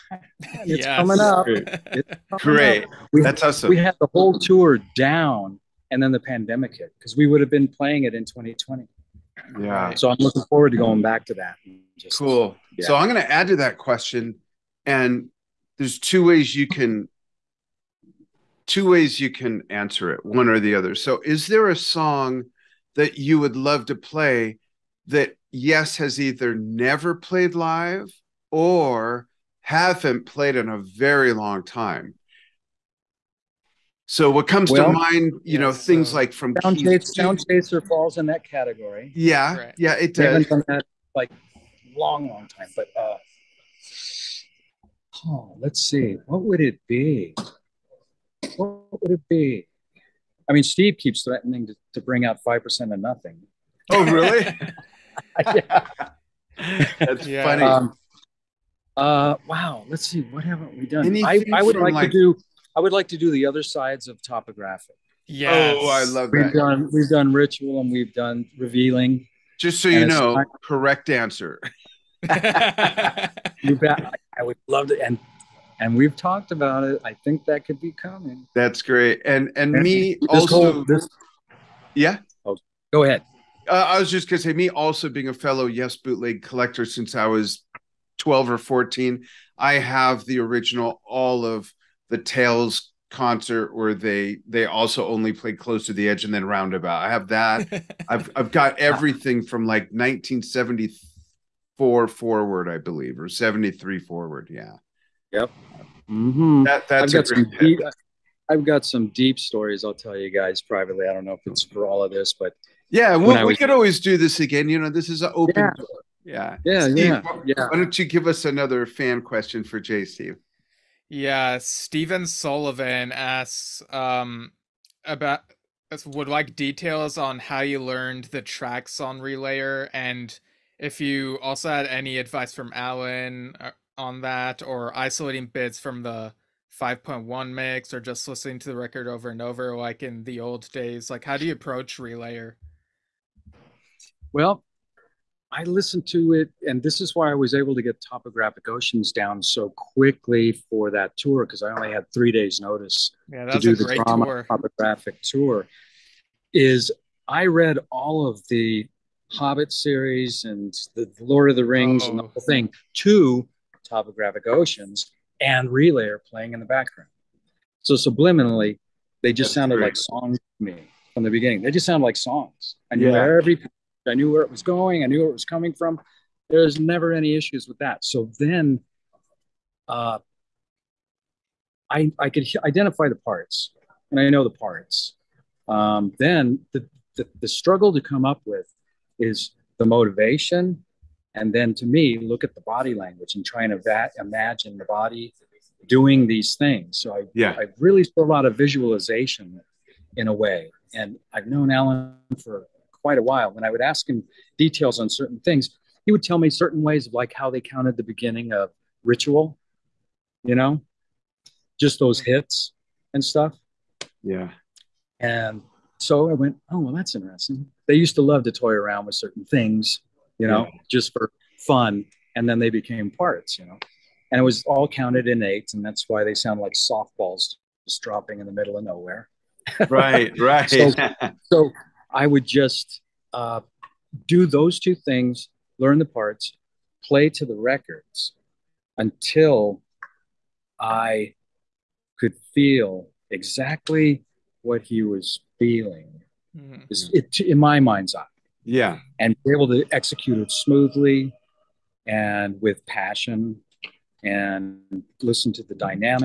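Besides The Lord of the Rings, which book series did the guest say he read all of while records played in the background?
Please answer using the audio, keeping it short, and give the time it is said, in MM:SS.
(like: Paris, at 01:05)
The Hobbit, at 02:39.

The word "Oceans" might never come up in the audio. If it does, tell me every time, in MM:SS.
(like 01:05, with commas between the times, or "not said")
02:28, 02:44.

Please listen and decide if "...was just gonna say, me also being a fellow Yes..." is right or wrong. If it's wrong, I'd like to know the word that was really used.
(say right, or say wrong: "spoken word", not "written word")
right.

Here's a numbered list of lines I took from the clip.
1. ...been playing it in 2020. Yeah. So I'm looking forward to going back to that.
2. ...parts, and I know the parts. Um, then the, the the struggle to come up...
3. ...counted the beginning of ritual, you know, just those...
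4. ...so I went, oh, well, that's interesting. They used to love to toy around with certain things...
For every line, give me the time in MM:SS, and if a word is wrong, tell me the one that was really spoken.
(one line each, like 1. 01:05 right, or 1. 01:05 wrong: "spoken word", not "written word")
1. 00:07 right
2. 03:03 right
3. 03:27 right
4. 03:35 right.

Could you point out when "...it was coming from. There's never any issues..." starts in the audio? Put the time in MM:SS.
02:55.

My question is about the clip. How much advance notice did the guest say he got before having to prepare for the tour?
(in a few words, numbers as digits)
3 days.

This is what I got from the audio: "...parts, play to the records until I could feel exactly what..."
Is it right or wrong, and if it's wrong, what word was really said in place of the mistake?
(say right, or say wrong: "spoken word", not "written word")
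right.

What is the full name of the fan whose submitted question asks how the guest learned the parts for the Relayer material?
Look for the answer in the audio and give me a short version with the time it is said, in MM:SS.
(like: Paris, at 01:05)
Stephen Sullivan, at 02:01.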